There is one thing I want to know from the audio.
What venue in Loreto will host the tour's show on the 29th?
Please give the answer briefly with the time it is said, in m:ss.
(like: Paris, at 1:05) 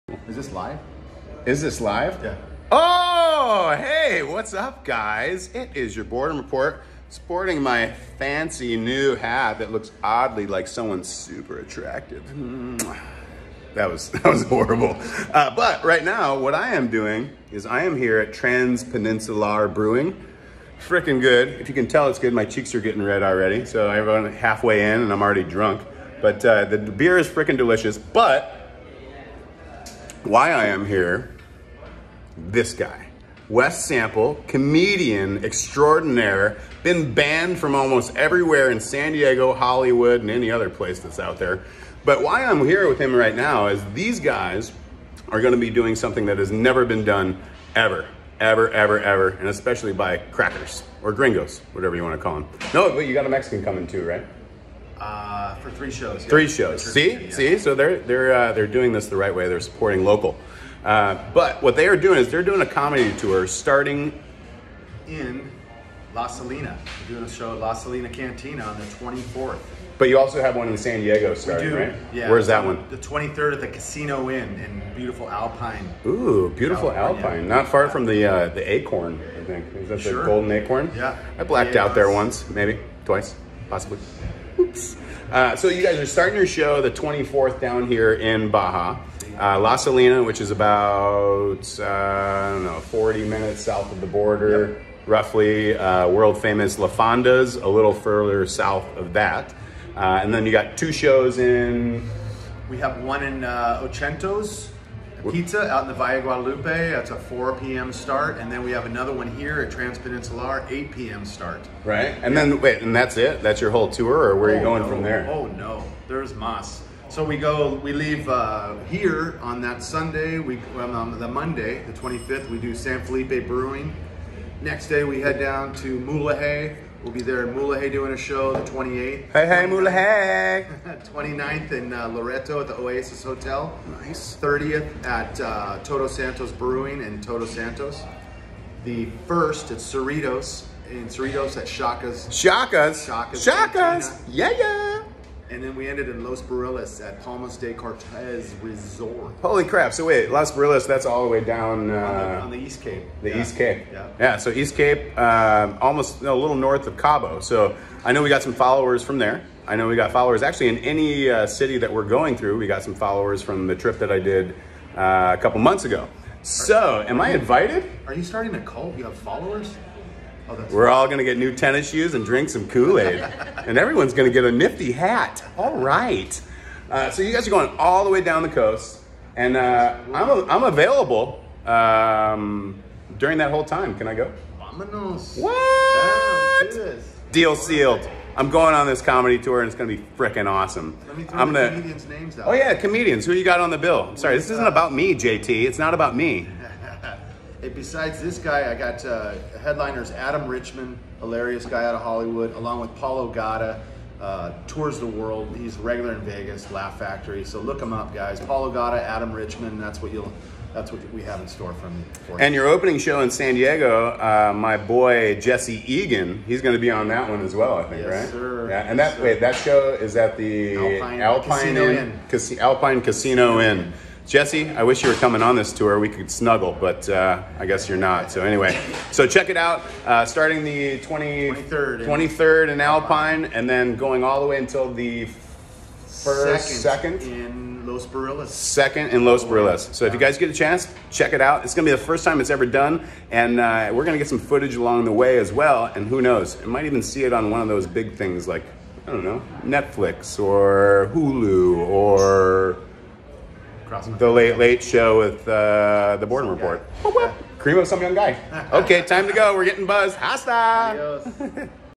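Oasis Hotel, at 2:12.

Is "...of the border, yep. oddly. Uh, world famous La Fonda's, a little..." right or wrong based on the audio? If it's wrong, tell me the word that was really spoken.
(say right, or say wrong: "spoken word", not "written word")
wrong: "roughly", not "oddly".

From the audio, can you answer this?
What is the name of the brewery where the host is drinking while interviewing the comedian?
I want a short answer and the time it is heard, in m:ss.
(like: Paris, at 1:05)
Transpeninsular Brewing, at 0:18.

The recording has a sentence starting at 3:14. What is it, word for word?
I'm sorry, this isn't about me, JT.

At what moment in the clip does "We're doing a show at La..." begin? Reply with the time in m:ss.
1:07.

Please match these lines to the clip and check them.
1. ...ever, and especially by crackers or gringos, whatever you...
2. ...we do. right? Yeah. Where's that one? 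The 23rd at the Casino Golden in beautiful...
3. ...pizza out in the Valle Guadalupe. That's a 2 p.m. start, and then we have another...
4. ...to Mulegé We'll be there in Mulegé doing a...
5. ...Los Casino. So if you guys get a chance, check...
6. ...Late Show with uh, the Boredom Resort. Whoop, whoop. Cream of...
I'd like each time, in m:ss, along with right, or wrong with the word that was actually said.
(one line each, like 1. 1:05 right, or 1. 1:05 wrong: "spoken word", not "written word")
1. 0:48 right
2. 1:11 wrong: "Inn", not "Golden"
3. 1:45 wrong: "4", not "2"
4. 2:05 right
5. 3:59 wrong: "Barriles", not "Casino"
6. 4:14 wrong: "Report", not "Resort".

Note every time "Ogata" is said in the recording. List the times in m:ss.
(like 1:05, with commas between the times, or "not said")
3:23, 3:28.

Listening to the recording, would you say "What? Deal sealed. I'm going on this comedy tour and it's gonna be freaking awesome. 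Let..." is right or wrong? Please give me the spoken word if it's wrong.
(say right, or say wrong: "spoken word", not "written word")
right.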